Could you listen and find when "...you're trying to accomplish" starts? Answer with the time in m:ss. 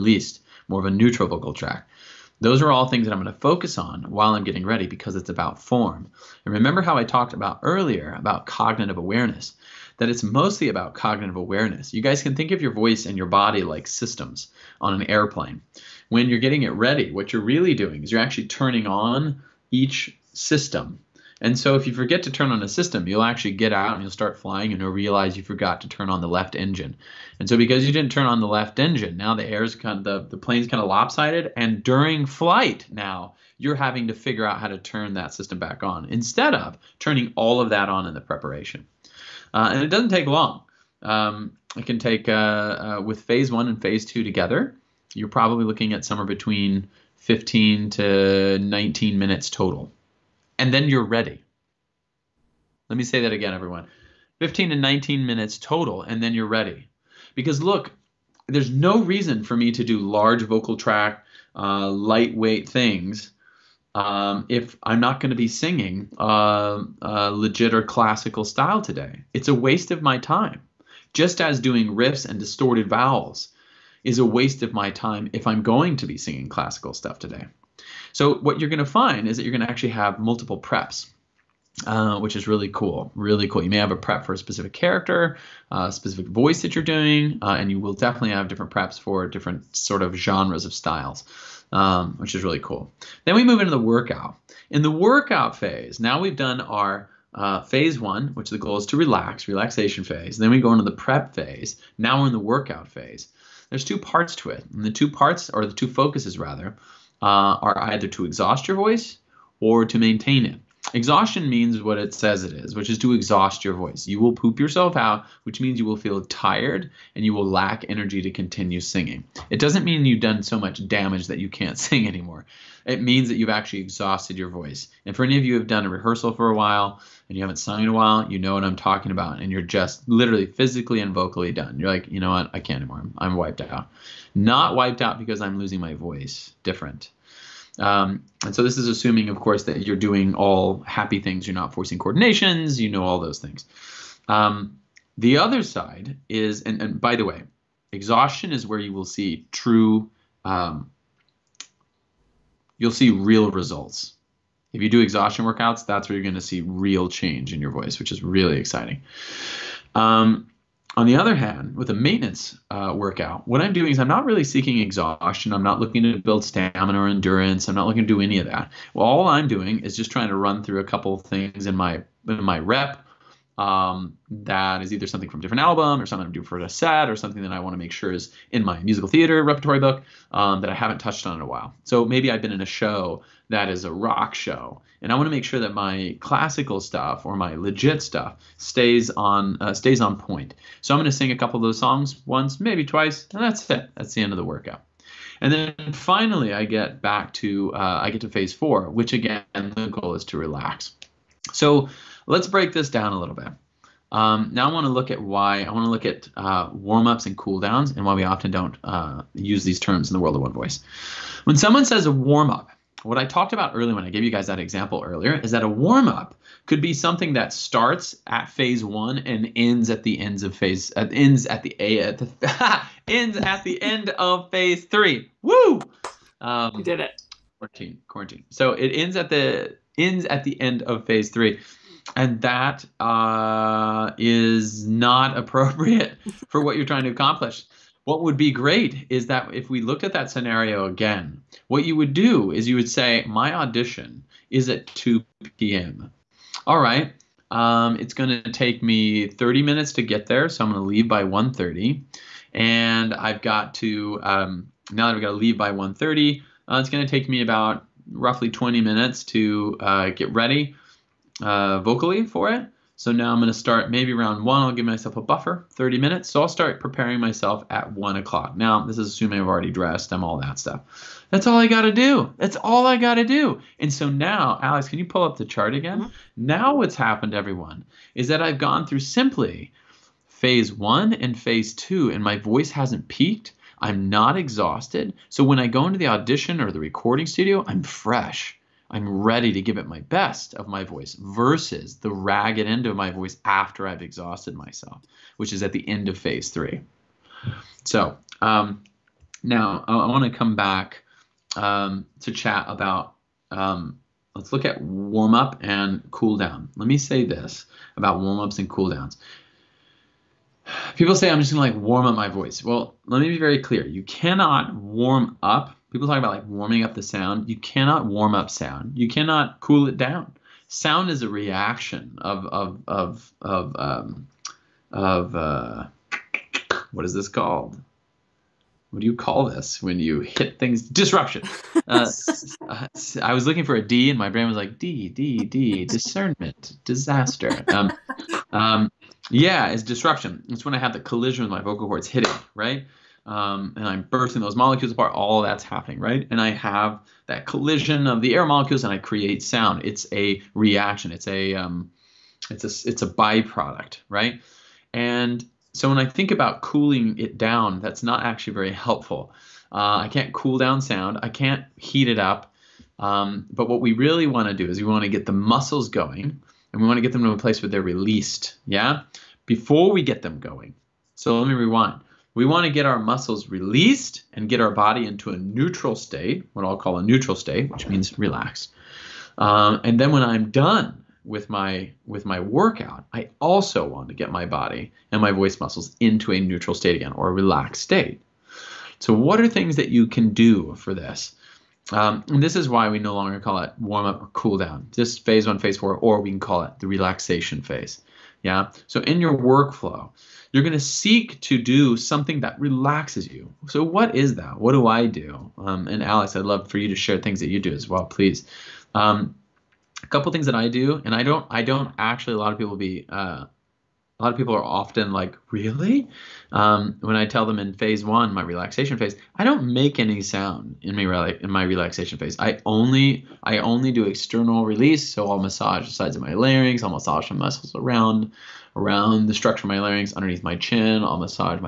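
3:56.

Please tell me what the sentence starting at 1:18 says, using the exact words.
So, what you're going to find is that you're going to actually have multiple preps.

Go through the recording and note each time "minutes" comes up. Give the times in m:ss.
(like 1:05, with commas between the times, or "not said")
0:49, 0:55, 4:09, 4:18, 4:25.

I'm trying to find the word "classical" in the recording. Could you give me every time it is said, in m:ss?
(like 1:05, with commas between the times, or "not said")
1:07, 1:16, 3:06.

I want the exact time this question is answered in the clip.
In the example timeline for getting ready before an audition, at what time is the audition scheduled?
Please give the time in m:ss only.
4:04.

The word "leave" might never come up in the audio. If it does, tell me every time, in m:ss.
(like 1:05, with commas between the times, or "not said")
4:10, 4:15.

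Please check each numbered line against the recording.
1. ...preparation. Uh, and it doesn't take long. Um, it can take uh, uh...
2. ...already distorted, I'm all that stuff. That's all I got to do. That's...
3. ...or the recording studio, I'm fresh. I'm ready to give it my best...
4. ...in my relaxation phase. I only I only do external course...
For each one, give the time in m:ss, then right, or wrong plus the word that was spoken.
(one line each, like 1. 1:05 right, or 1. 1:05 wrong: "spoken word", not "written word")
1. 0:38 right
2. 4:29 wrong: "dressed", not "distorted"
3. 4:46 right
4. 7:01 wrong: "release", not "course".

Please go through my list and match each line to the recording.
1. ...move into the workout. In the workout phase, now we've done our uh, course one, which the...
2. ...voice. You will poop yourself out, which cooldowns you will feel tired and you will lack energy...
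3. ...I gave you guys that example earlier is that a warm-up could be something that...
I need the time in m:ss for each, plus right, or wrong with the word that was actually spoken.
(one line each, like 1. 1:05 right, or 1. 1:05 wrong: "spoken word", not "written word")
1. 1:33 wrong: "phase", not "course"
2. 1:53 wrong: "means", not "cooldowns"
3. 3:34 right.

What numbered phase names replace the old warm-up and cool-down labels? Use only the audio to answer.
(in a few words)
phase one, phase four.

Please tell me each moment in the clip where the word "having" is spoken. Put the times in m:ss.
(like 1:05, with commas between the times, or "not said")
0:33.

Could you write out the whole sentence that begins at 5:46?
And I have that collision of the air molecules, and I create sound.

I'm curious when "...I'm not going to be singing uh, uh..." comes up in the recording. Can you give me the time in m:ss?
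1:04.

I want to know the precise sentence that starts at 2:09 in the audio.
And you're just literally physically and vocally done.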